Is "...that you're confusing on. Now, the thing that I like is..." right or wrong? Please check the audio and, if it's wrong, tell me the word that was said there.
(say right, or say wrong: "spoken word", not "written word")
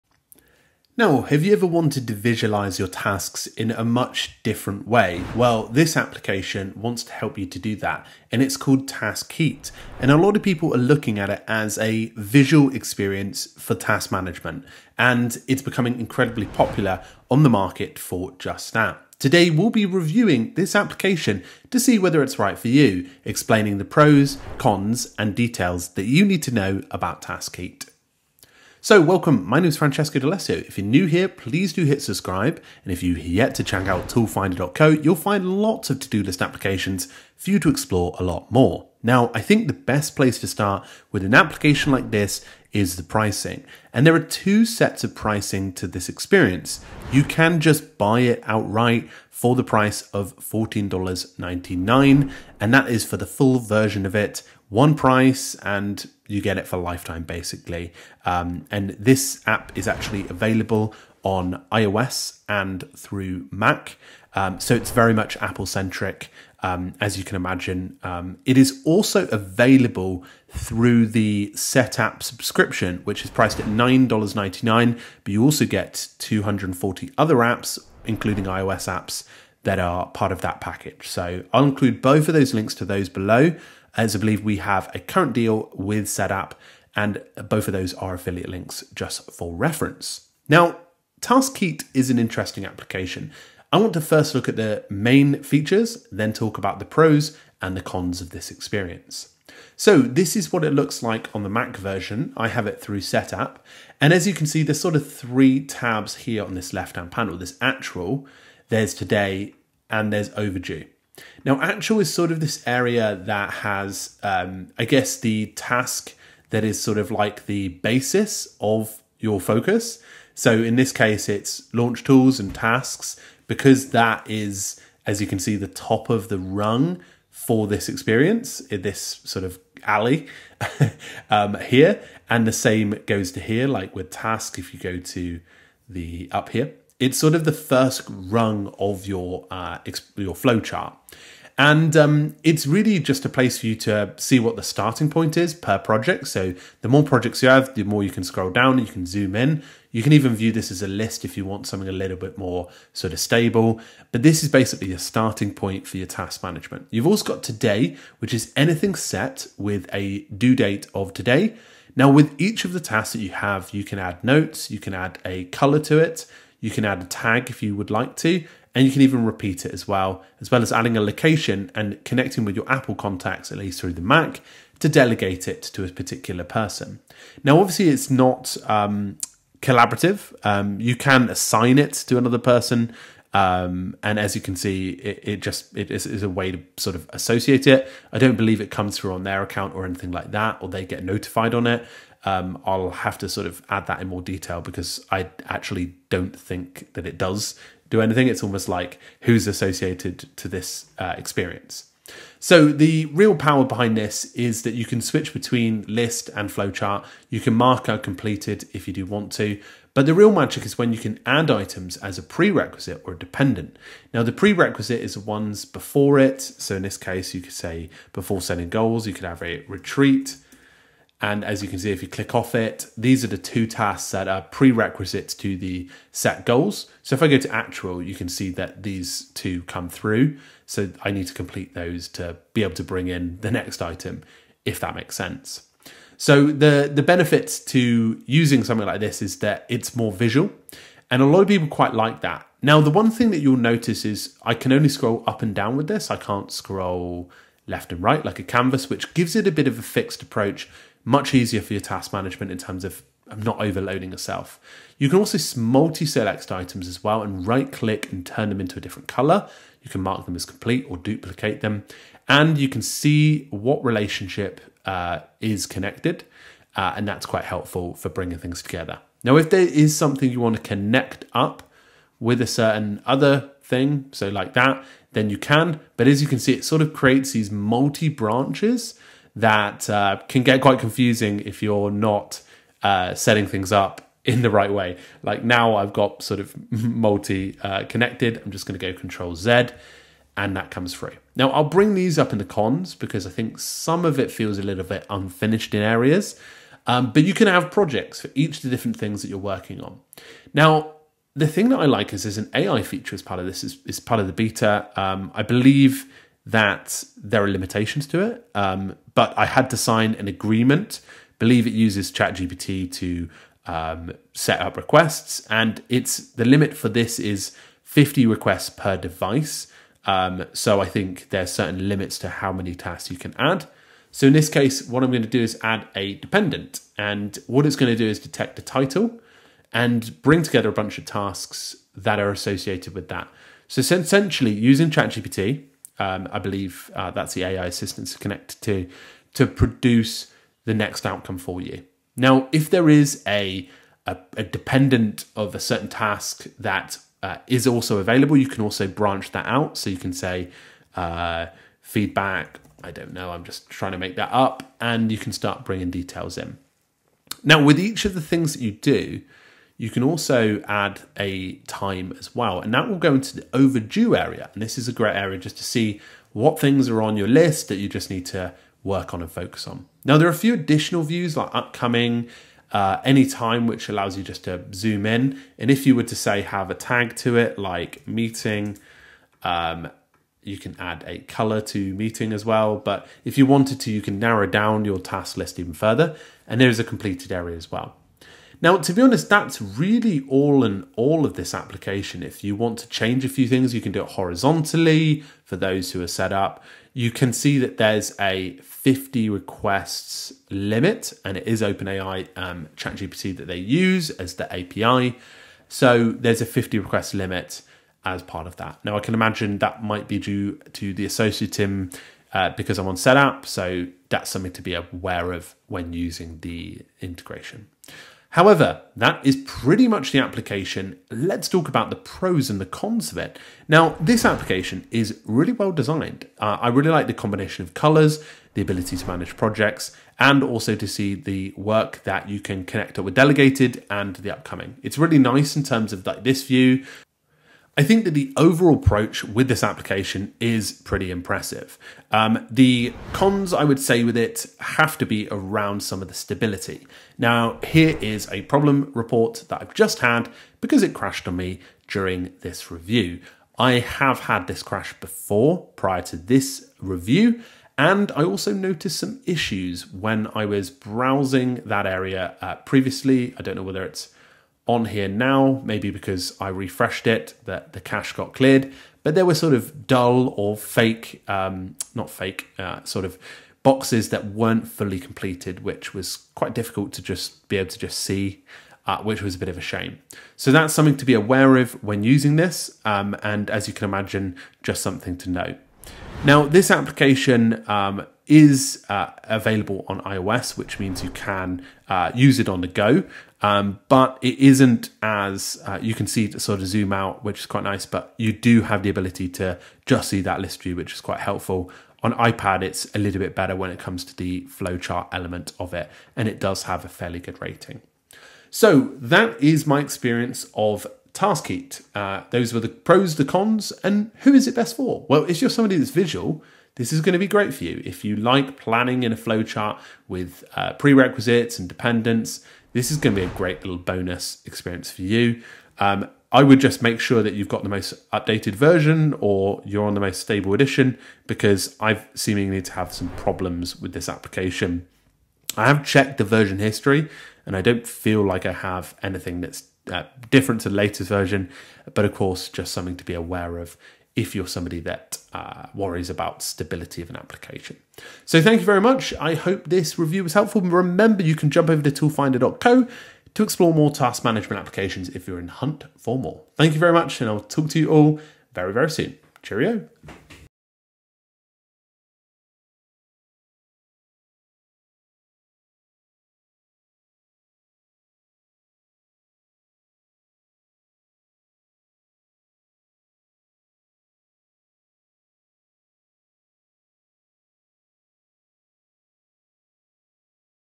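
wrong: "working", not "confusing".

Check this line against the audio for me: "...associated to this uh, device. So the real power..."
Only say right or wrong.
wrong.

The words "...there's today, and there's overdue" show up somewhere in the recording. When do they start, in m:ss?
1:48.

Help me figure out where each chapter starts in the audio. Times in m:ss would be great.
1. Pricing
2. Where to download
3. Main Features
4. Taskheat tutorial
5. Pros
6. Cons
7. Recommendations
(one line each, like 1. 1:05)
1. 0:40
2. 0:55
3. 1:20
4. 3:00
5. 5:30
6. 6:00
7. 7:00.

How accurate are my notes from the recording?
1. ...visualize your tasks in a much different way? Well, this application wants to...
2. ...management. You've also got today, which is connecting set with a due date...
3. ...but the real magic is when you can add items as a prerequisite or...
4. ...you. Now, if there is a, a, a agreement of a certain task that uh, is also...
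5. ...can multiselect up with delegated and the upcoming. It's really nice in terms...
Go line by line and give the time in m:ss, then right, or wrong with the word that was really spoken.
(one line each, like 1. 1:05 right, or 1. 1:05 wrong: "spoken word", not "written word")
1. 0:02 right
2. 2:36 wrong: "anything", not "connecting"
3. 3:29 right
4. 5:41 wrong: "dependent", not "agreement"
5. 7:12 wrong: "connect", not "multiselect".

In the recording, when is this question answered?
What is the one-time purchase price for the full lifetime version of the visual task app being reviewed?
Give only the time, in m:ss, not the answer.
0:50.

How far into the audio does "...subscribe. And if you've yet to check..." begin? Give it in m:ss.
0:32.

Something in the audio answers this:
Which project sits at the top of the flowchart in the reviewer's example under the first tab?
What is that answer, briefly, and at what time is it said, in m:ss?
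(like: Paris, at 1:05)
launch tools and tasks, at 2:01.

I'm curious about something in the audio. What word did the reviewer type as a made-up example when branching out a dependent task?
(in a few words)
feedback.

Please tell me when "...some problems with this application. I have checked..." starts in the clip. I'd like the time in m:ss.
8:52.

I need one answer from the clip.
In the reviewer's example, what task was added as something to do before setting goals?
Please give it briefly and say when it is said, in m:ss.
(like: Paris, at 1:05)
a retreat, at 3:39.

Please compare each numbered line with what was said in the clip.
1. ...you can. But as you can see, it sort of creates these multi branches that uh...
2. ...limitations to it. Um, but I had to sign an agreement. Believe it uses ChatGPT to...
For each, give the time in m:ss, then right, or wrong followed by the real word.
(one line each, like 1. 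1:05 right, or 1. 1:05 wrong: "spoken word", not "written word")
1. 4:35 right
2. 5:07 right.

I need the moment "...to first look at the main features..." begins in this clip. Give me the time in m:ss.
1:33.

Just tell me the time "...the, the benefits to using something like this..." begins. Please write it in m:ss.
3:56.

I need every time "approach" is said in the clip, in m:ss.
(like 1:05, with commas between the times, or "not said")
4:10, 7:18.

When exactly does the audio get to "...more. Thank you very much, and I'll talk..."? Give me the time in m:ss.
9:16.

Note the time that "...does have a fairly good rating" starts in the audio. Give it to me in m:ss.
8:26.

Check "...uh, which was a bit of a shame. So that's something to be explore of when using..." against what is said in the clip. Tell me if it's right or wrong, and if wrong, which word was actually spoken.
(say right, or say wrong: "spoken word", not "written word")
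wrong: "aware", not "explore".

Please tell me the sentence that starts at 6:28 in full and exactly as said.
Now, to be honest, that's really all in all of this application.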